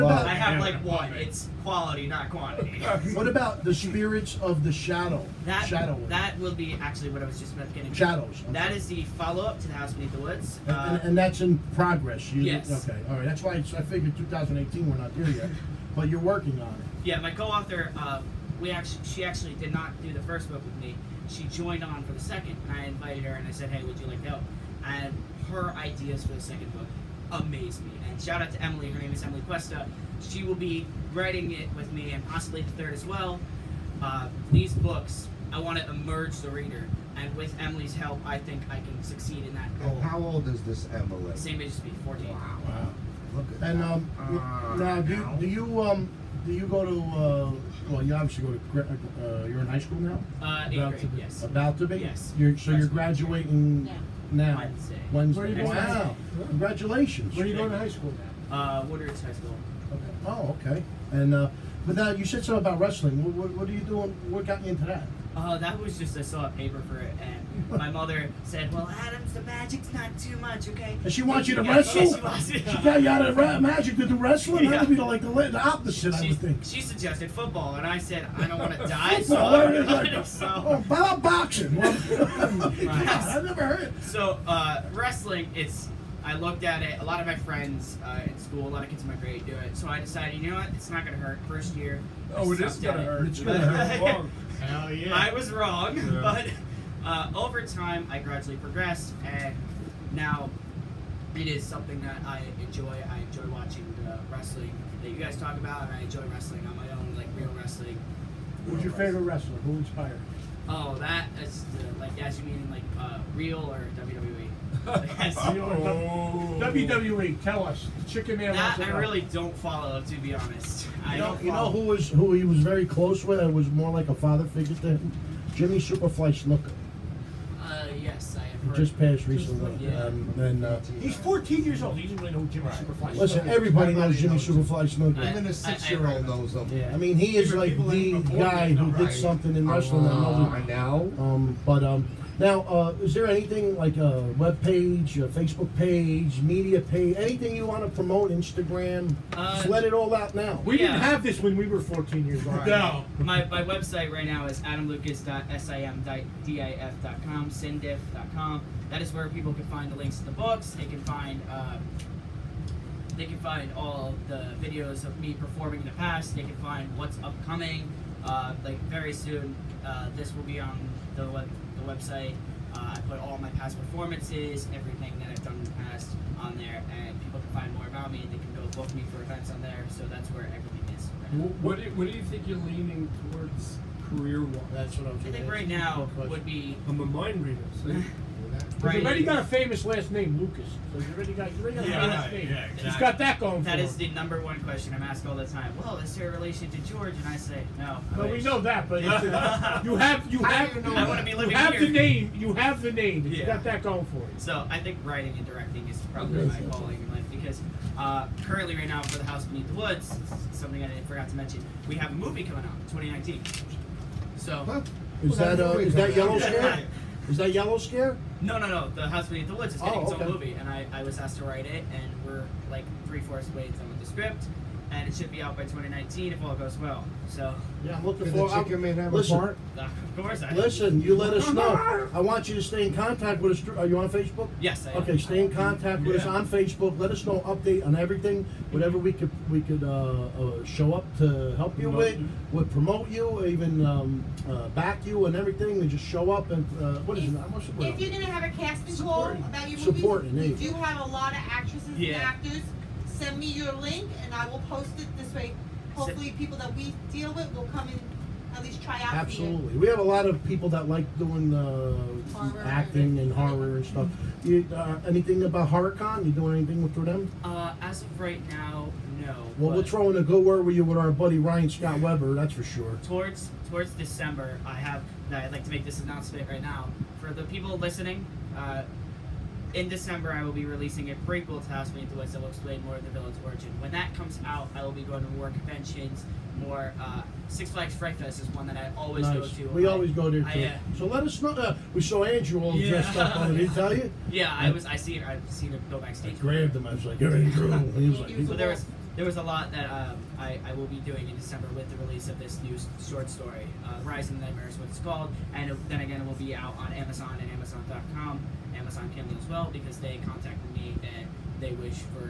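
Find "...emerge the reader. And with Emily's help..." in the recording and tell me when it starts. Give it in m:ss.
0:35.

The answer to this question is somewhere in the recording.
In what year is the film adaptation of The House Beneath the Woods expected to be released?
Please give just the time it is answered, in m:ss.
3:31.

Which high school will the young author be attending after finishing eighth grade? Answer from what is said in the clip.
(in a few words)
Woodridge High School.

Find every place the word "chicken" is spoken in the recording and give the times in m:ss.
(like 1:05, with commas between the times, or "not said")
1:58, 3:48.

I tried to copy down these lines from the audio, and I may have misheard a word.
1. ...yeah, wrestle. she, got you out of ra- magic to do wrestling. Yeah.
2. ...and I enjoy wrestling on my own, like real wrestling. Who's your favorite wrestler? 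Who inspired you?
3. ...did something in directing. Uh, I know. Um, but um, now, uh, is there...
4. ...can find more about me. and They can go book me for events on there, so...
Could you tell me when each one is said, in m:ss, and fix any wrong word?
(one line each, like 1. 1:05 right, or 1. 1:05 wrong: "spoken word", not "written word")
1. 1:11 right
2. 1:45 right
3. 2:18 wrong: "wrestling", not "directing"
4. 2:57 right.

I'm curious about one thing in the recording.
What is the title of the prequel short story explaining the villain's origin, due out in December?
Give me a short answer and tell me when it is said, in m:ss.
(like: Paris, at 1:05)
Rise of the Nightmare, at 5:04.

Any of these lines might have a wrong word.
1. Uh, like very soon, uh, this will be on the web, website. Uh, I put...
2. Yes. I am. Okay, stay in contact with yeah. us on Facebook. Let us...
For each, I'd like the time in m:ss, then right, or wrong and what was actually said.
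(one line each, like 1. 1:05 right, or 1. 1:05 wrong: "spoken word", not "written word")
1. 2:48 right
2. 3:54 right.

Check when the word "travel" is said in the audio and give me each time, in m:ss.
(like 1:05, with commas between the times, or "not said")
not said.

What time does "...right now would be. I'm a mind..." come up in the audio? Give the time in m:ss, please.
3:05.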